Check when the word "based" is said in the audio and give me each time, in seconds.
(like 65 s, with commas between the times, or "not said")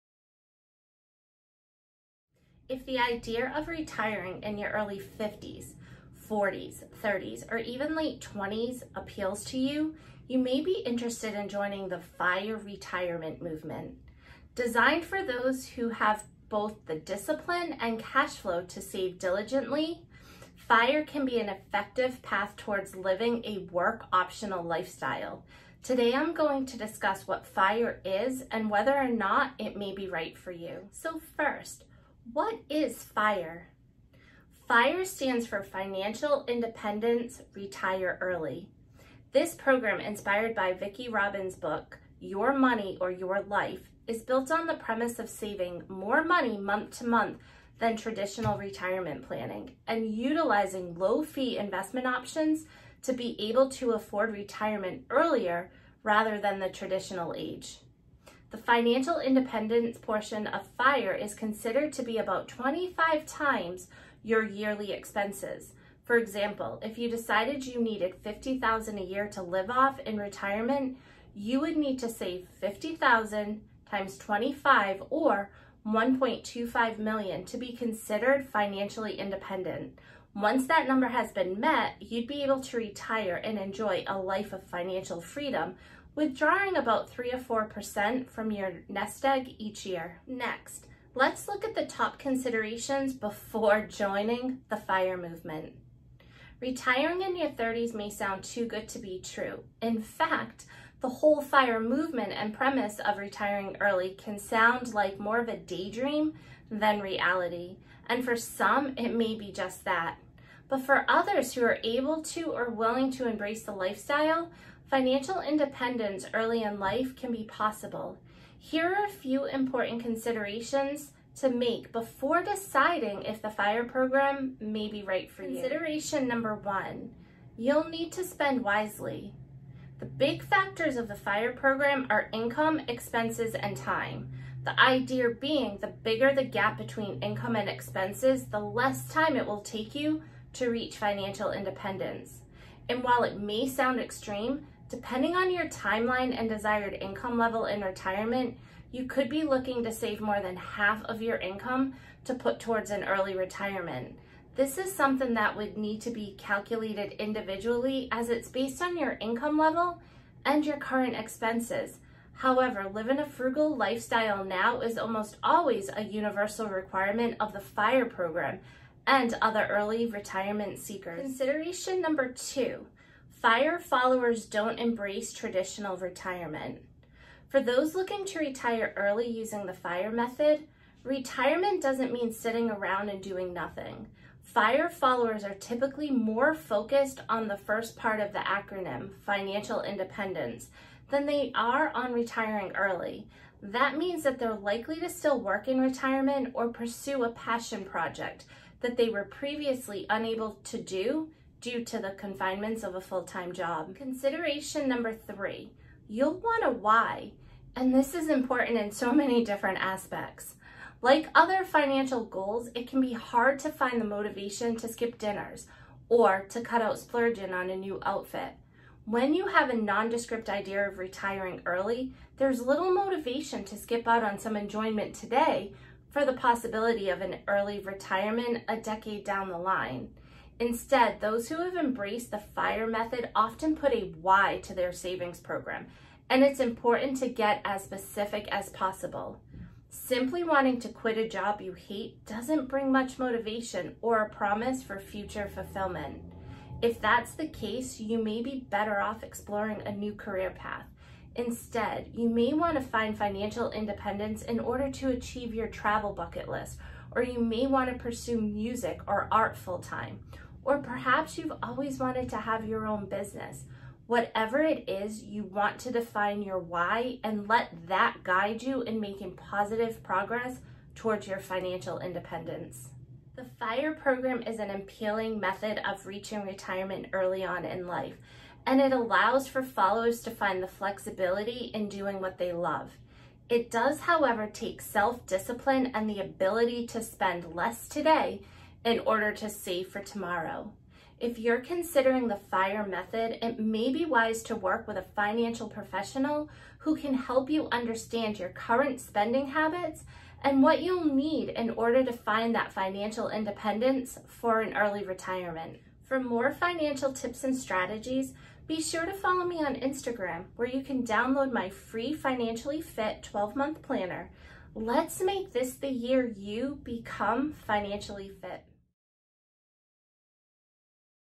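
158 s.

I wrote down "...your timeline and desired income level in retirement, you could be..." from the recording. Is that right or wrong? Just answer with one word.
right.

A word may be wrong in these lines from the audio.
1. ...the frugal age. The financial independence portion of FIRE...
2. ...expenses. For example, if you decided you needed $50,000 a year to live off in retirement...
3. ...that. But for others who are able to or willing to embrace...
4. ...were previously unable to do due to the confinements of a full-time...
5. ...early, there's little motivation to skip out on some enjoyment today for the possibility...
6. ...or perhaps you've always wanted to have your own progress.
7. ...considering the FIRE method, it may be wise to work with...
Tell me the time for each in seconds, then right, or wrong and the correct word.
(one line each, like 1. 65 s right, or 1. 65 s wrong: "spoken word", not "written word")
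1. 56 s wrong: "traditional", not "frugal"
2. 64 s right
3. 109 s right
4. 199 s right
5. 221 s right
6. 260 s wrong: "business", not "progress"
7. 291 s right.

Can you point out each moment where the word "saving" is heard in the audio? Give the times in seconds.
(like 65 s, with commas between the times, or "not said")
45 s, 234 s.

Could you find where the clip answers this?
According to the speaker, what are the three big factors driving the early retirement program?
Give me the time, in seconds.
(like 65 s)
132 s.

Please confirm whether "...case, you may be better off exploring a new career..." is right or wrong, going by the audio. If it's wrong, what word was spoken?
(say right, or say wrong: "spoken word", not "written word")
right.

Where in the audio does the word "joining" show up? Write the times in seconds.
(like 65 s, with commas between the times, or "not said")
11 s, 93 s.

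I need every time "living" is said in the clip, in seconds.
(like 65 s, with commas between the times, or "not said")
22 s, 162 s.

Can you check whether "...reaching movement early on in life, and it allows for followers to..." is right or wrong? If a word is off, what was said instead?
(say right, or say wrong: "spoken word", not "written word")
wrong: "retirement", not "movement".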